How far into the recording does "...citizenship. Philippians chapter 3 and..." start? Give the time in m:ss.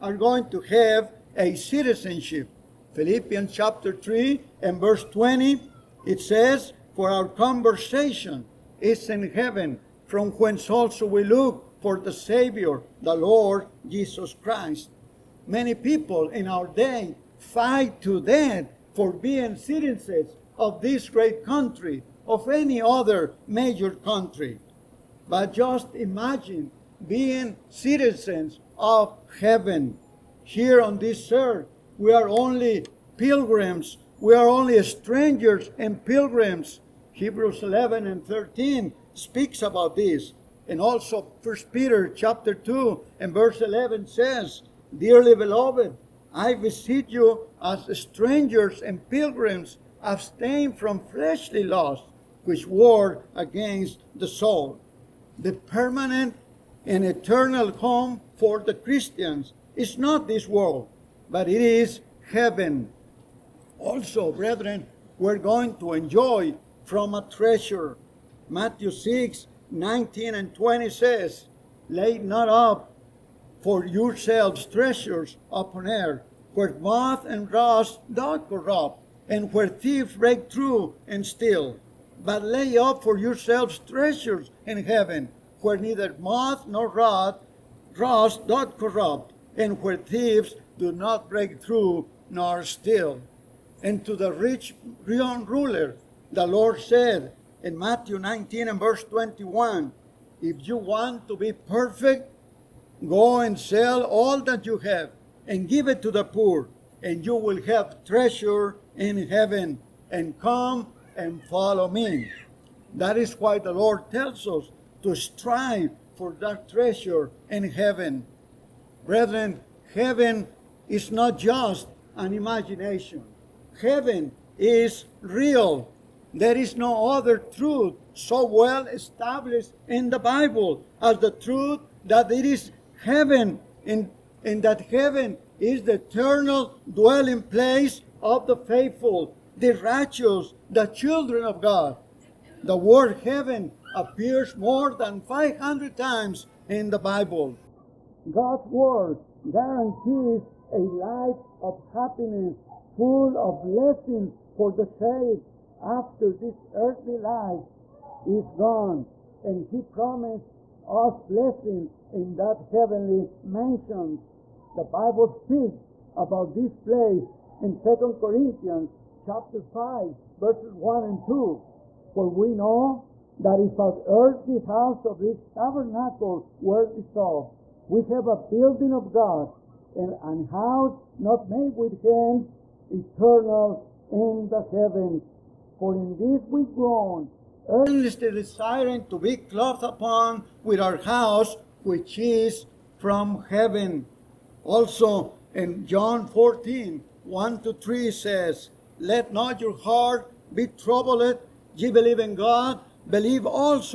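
0:01.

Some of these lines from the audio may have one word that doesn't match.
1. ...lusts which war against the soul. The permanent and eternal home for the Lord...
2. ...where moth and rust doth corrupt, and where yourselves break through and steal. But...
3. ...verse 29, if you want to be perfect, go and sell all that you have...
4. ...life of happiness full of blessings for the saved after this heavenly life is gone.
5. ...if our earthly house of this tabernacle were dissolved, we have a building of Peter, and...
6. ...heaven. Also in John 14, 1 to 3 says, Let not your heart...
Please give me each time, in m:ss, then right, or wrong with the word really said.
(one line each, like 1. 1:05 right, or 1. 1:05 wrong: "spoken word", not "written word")
1. 0:51 wrong: "Christians", not "Lord"
2. 1:16 wrong: "thieves", not "yourselves"
3. 1:38 wrong: "21", not "29"
4. 2:30 wrong: "earthly", not "heavenly"
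5. 2:53 wrong: "God", not "Peter"
6. 3:13 right.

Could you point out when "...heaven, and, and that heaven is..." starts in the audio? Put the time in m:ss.
2:13.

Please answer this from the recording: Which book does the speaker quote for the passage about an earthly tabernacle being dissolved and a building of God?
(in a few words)
Second Corinthians.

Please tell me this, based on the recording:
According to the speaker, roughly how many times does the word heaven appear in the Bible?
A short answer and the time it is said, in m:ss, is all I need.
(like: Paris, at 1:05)
More than 500, at 2:24.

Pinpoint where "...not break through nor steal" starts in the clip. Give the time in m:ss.
1:30.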